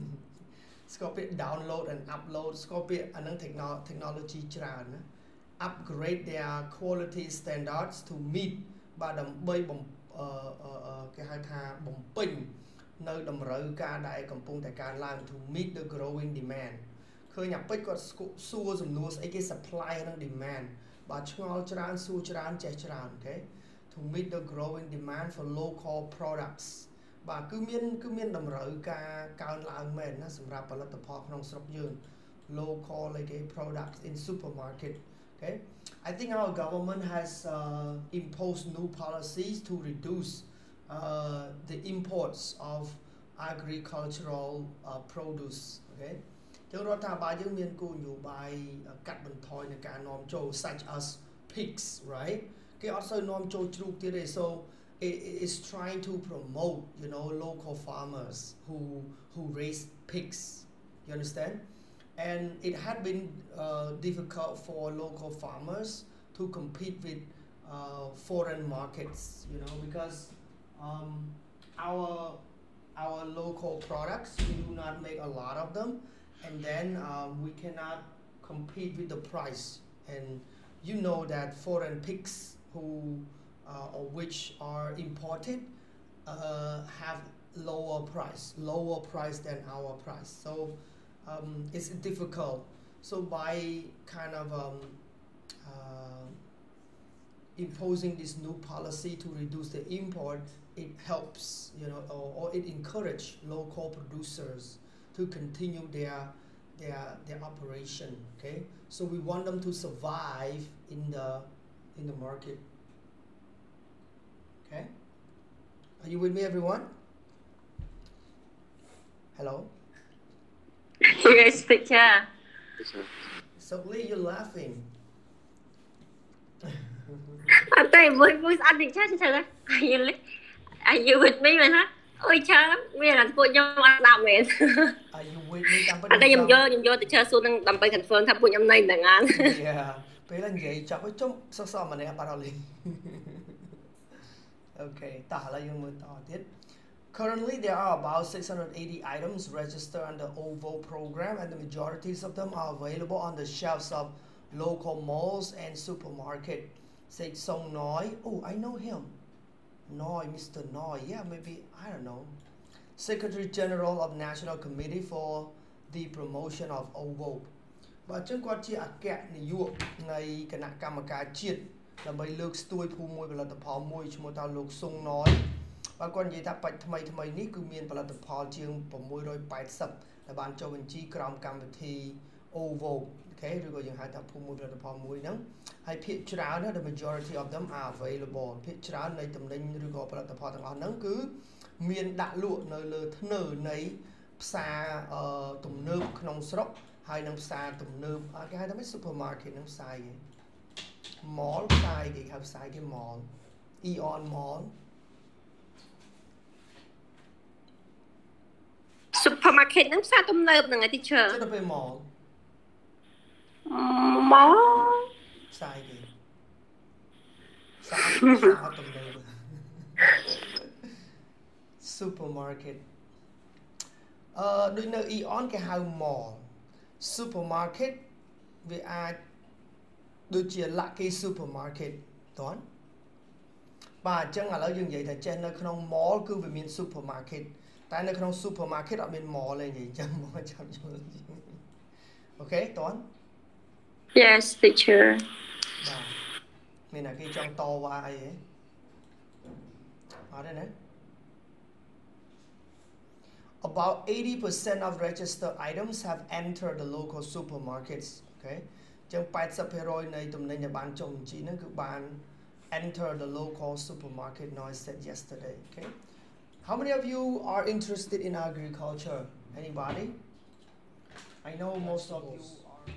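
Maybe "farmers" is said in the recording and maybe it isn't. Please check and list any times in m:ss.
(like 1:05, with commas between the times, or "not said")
0:57, 1:05.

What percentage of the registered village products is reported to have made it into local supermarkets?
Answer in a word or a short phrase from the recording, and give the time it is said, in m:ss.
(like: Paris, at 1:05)
80%, at 4:13.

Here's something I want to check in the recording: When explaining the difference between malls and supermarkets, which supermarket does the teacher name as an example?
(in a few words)
Lucky supermarket.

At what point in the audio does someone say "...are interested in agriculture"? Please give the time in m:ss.
4:27.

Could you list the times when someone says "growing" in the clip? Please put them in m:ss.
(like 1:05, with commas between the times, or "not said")
0:15, 0:24.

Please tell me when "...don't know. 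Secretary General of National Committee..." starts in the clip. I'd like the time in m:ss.
2:41.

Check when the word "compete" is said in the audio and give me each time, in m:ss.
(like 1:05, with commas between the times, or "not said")
1:06, 1:18.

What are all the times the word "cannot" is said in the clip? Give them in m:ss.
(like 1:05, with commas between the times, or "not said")
1:17.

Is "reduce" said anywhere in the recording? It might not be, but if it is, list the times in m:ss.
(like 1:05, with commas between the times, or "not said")
0:39, 1:39.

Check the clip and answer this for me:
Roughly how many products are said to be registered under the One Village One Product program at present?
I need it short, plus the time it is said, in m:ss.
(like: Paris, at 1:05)
680, at 2:27.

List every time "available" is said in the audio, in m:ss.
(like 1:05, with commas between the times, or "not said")
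2:32, 3:07.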